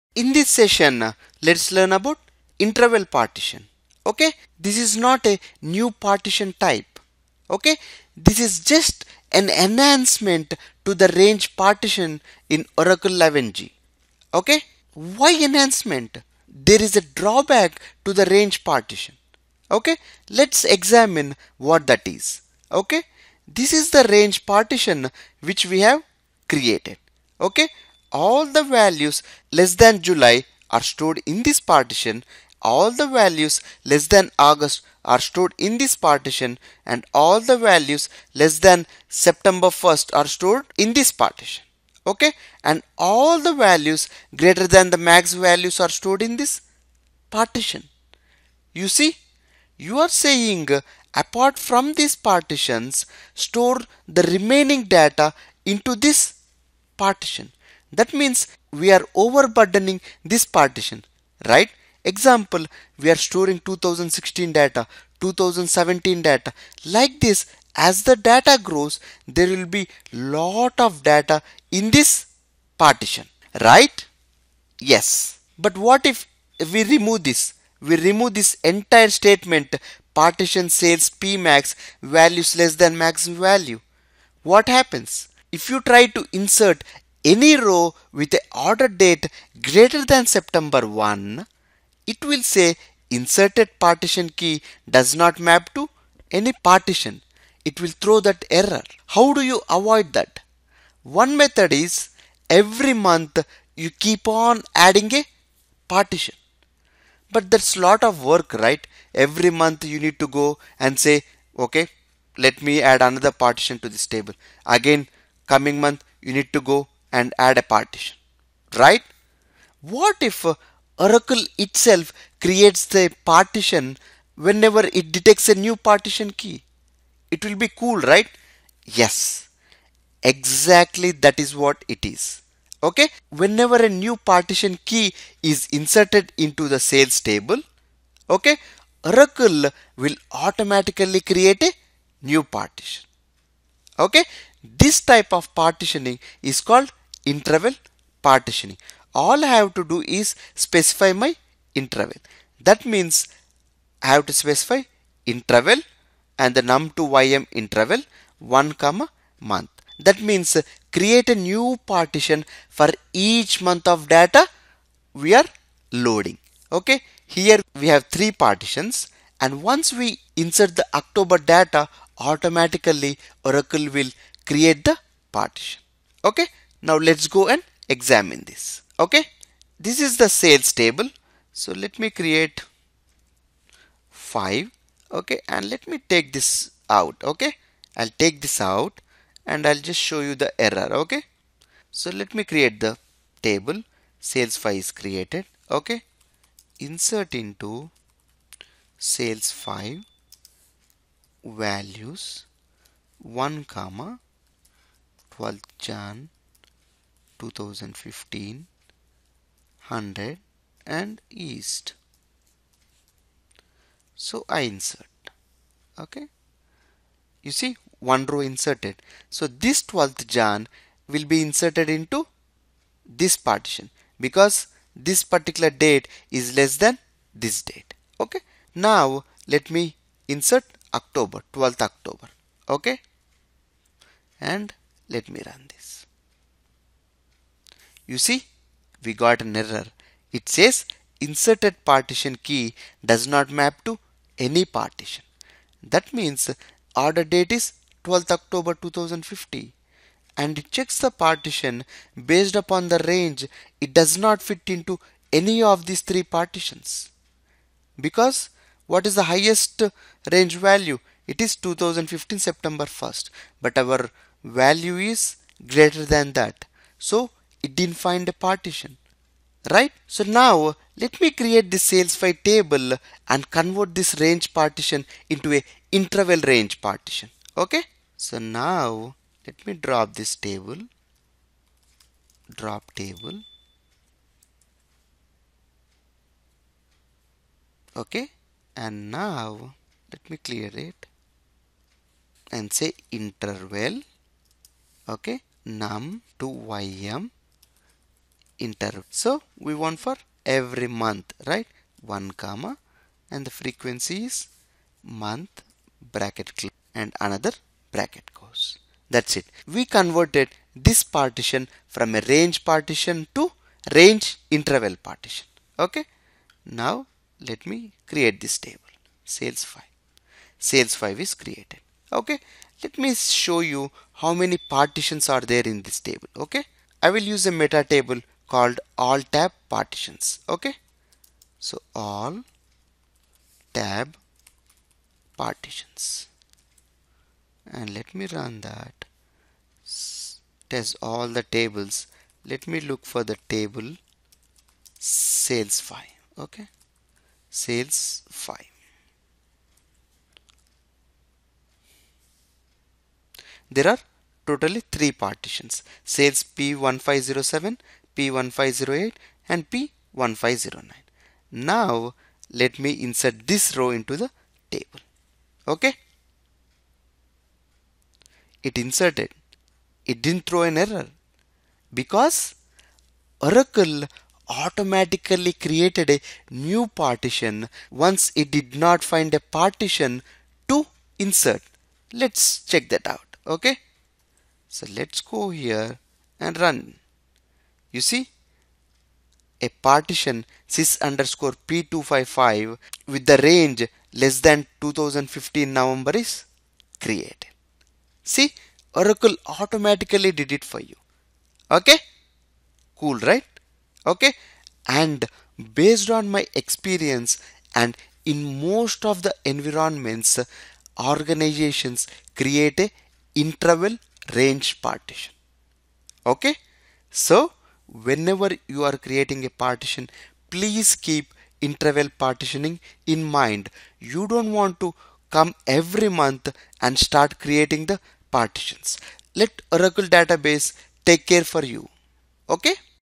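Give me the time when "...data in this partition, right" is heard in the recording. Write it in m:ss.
1:11.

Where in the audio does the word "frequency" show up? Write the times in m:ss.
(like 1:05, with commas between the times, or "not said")
5:03.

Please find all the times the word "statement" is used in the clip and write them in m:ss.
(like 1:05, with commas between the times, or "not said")
1:19.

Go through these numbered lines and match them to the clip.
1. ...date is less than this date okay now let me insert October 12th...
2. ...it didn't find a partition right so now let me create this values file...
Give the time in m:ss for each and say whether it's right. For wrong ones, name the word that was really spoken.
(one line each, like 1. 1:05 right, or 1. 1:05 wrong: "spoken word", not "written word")
1. 3:45 right
2. 4:27 wrong: "sales", not "values".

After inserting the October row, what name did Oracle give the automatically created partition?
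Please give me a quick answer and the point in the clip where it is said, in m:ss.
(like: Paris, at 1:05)
SYS_P255, at 6:30.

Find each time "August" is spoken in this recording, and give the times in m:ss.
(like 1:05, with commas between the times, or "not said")
0:34.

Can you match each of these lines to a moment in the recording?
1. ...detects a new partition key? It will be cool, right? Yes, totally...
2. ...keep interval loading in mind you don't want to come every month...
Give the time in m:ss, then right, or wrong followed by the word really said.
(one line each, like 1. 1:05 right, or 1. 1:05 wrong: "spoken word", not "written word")
1. 2:05 wrong: "exactly", not "totally"
2. 7:00 wrong: "partitioning", not "loading".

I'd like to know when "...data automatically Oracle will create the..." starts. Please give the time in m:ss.
2:51.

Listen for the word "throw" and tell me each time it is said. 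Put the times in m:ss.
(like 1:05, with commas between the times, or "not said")
1:38, 6:10.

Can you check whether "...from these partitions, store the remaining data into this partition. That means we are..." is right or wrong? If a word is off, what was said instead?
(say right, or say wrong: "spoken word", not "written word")
right.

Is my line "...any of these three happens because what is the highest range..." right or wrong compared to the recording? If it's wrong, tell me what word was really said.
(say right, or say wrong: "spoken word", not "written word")
wrong: "partitions", not "happens".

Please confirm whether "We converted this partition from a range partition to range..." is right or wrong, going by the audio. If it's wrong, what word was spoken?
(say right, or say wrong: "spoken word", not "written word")
right.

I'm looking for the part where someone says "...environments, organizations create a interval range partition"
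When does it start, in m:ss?
6:49.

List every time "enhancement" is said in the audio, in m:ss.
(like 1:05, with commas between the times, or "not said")
0:09, 0:15.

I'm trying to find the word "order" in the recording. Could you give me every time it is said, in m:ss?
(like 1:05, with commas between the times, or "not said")
1:28, 4:07.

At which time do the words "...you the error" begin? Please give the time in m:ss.
3:10.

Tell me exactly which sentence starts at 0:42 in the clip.
Okay, and all the values greater than the max values are stored in this partition.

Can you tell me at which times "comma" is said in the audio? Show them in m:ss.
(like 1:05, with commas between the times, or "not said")
2:38, 3:23, 5:02.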